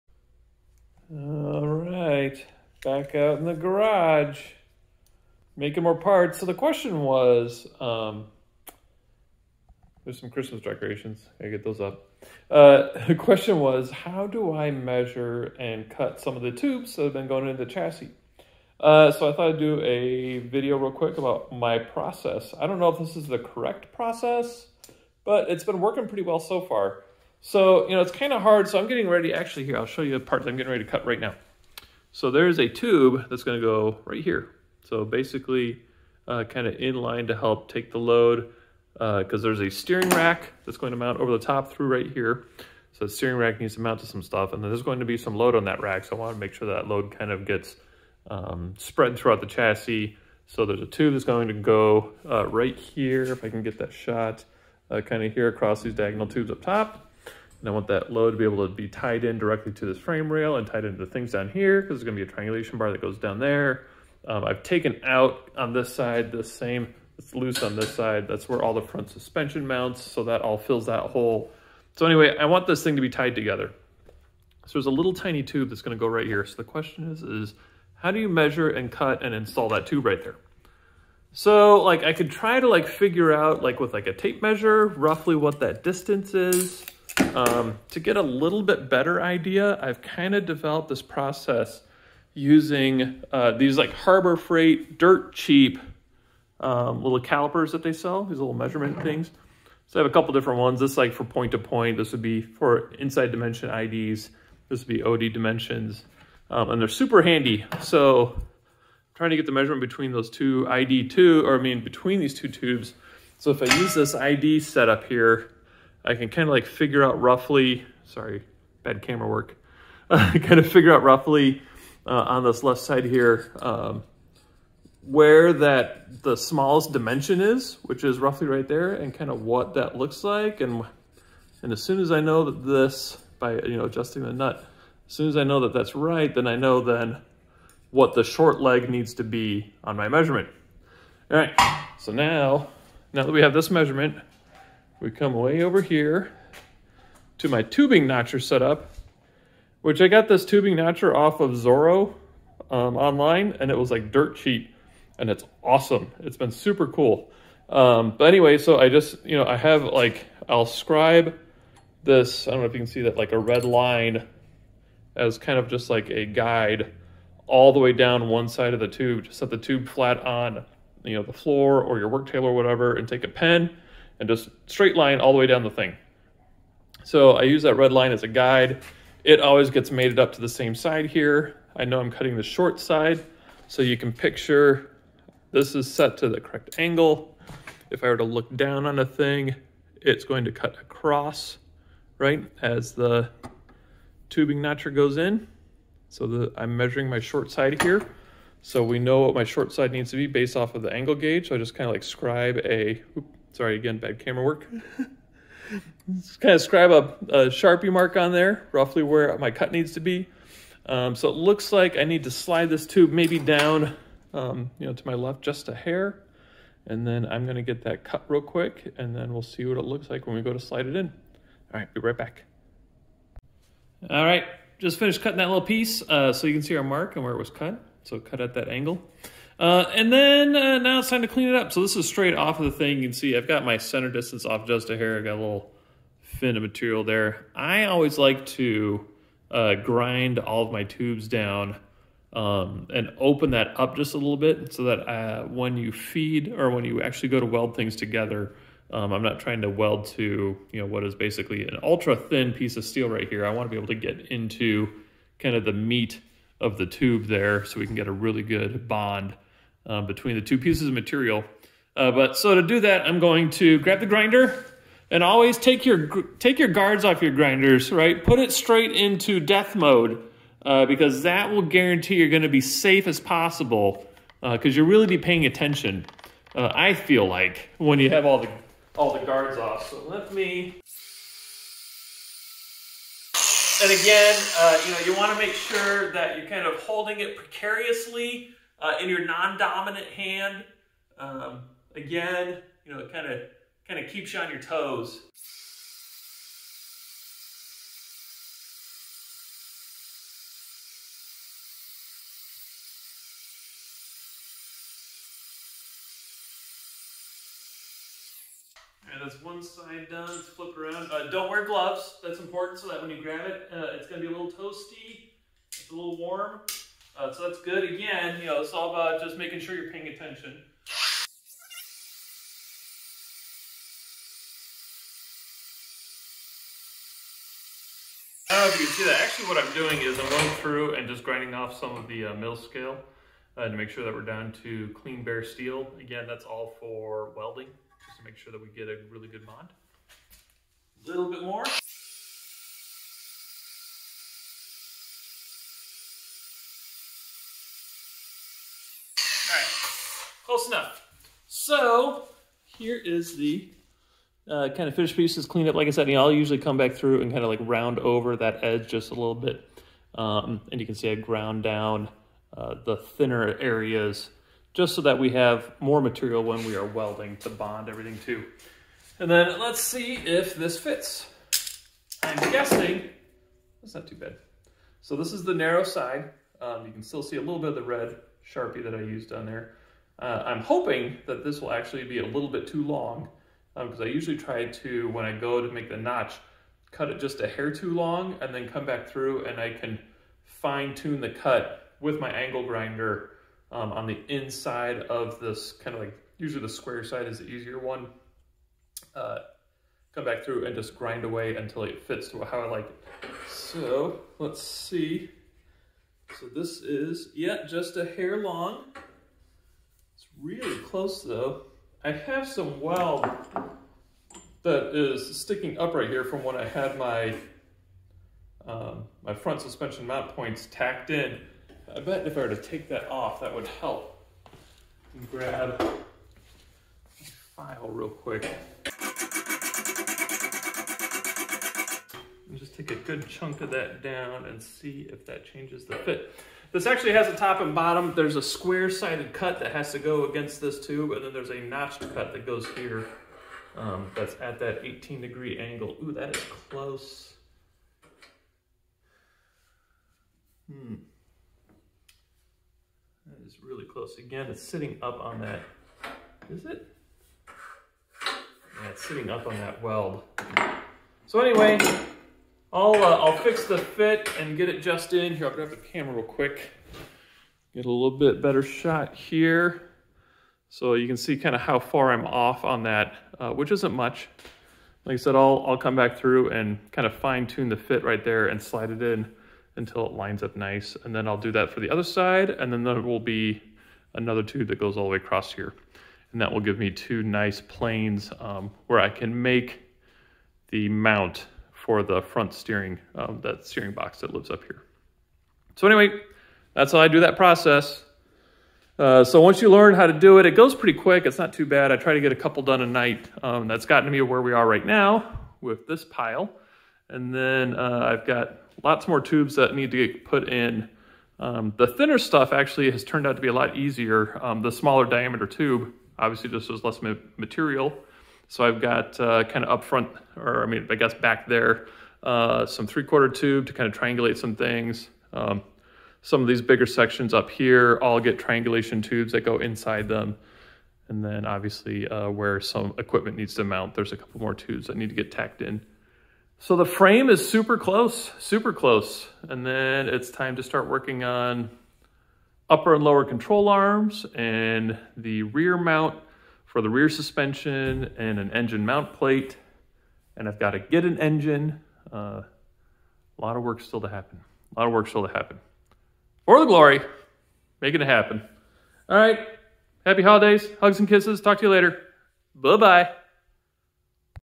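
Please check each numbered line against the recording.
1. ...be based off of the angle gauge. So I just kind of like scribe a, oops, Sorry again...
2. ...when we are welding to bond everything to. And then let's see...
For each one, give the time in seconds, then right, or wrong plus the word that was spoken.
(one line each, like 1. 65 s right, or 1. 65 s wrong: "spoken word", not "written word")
1. 200 s right
2. 366 s right.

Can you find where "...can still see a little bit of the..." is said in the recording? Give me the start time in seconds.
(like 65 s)
376 s.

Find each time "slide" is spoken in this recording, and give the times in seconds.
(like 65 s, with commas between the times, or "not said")
212 s, 220 s, 478 s.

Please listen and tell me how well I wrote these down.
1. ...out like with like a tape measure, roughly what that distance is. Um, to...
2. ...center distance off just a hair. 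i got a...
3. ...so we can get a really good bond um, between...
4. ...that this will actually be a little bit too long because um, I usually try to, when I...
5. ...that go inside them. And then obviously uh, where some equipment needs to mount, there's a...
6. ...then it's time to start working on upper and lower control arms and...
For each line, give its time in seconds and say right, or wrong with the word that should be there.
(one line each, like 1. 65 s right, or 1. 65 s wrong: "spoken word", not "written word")
1. 83 s right
2. 233 s right
3. 257 s right
4. 381 s right
5. 529 s right
6. 539 s right.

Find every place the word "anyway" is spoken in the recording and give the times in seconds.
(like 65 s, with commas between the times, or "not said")
72 s, 158 s, 461 s, 495 s.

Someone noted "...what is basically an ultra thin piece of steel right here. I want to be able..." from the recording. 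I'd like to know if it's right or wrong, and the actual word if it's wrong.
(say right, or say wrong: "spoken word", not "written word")
right.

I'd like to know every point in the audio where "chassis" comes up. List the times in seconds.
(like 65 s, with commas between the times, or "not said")
17 s, 49 s.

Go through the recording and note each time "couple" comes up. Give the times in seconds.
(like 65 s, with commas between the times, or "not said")
100 s, 502 s, 534 s.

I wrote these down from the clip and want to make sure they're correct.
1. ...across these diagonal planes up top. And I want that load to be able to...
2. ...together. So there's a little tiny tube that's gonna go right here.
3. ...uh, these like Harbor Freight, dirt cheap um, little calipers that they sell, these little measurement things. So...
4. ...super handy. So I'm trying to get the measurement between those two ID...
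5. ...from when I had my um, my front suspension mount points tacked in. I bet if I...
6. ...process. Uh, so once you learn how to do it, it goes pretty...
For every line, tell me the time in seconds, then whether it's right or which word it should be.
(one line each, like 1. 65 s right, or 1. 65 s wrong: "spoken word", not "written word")
1. 55 s wrong: "tubes", not "planes"
2. 73 s right
3. 93 s right
4. 106 s right
5. 416 s right
6. 497 s right.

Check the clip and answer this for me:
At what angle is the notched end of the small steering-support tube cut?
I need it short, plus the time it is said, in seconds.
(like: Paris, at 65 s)
18 degrees, at 444 s.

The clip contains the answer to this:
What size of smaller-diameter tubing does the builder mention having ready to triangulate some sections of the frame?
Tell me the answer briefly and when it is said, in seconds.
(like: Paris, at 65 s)
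three quarter, at 522 s.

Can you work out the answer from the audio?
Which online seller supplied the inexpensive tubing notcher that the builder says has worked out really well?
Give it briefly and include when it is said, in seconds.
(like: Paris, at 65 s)
Zoro, at 151 s.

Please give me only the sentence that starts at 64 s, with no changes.
Um, I've taken out on this side the same, it's loose on this side.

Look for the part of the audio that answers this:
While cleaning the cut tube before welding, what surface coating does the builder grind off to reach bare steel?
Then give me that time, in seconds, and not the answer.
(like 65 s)
332 s.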